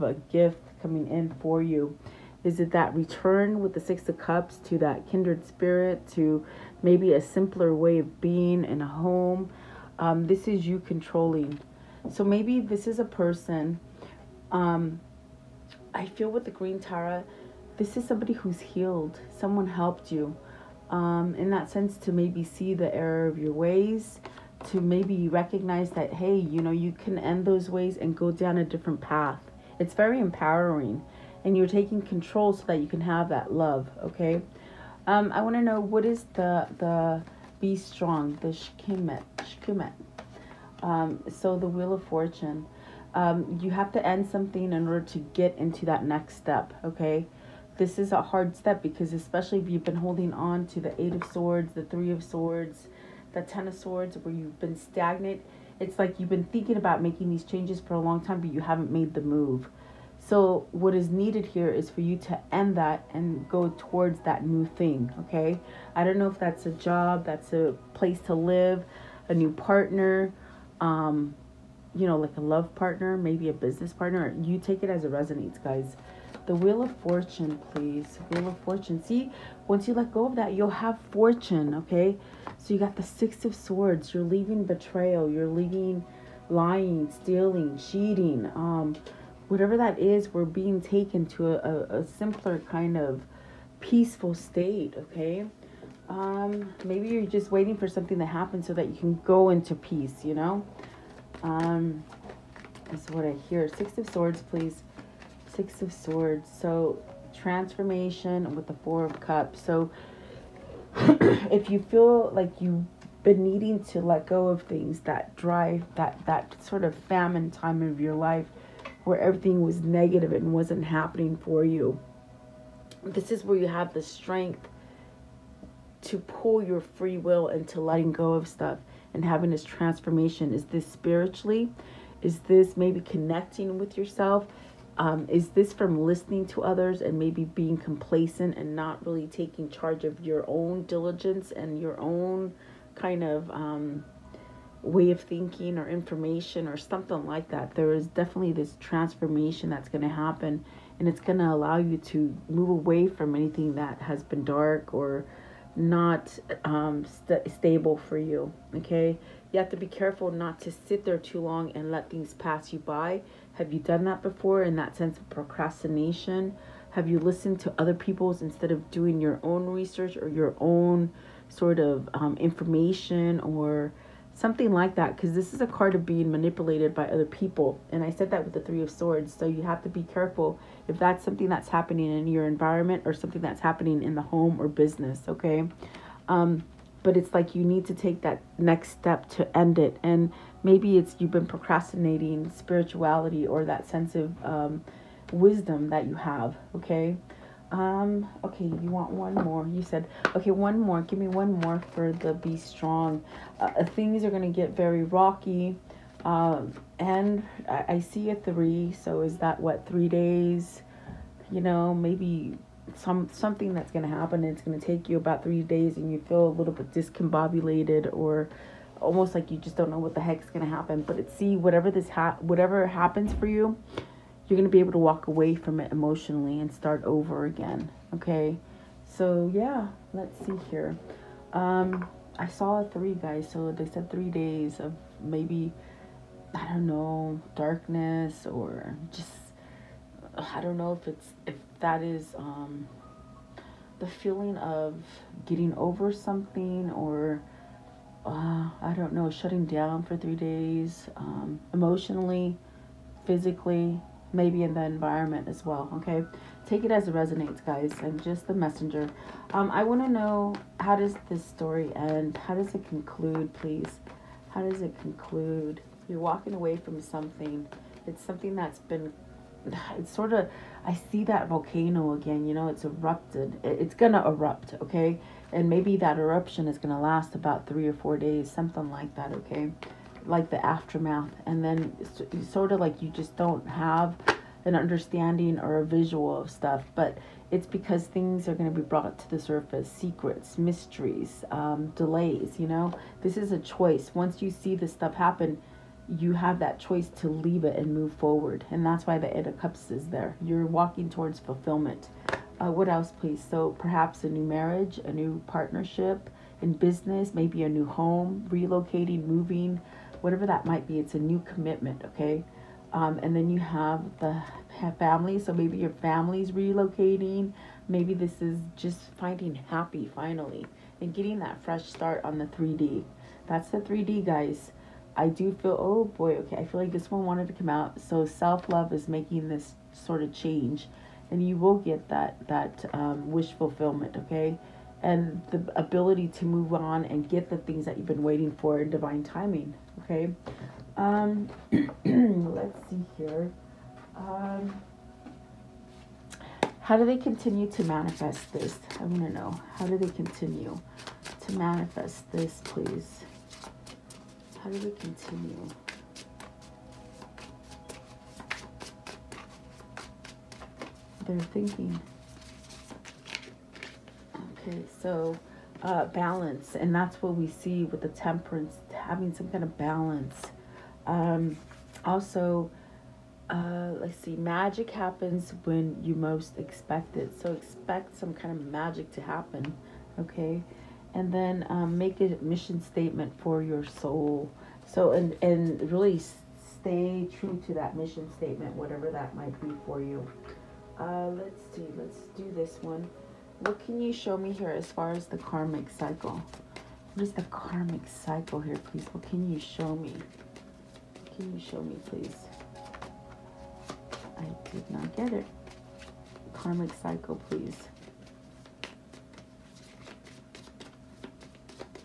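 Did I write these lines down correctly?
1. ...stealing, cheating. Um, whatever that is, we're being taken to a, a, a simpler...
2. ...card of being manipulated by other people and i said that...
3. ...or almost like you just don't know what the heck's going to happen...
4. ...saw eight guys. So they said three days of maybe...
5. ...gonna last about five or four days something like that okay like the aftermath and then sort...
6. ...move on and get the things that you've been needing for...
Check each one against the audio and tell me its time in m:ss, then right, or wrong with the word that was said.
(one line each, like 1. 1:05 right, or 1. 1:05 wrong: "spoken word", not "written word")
1. 1:27 right
2. 2:55 right
3. 3:38 right
4. 3:52 wrong: "three", not "eight"
5. 4:36 wrong: "three", not "five"
6. 5:36 wrong: "waiting", not "needing".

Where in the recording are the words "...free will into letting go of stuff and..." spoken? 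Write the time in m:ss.
2:06.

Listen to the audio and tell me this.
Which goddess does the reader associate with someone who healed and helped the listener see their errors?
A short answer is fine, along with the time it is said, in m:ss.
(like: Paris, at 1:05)
Green Tara, at 0:16.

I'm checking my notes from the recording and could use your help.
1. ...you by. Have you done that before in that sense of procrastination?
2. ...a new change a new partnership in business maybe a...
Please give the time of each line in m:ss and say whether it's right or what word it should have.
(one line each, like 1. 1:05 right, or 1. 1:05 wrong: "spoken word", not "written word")
1. 2:42 right
2. 5:04 wrong: "marriage", not "change".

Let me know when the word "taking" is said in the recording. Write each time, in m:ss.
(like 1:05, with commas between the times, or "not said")
0:31, 2:19.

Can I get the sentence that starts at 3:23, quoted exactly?
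Uh, things are going to get very rocky.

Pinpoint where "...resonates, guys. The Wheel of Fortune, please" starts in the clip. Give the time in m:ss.
1:15.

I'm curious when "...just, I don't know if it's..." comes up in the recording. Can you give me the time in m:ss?
3:59.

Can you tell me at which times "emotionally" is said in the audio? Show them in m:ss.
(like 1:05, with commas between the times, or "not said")
3:45, 4:11.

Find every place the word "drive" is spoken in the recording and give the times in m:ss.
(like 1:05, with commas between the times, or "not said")
1:55.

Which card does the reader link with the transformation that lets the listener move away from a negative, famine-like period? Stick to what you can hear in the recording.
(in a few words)
Four of Cups.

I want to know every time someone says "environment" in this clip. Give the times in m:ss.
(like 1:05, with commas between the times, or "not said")
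3:02, 4:14.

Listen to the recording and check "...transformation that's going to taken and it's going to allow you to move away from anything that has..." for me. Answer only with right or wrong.
wrong.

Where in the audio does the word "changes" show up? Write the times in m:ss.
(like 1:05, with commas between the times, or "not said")
0:57, 5:30.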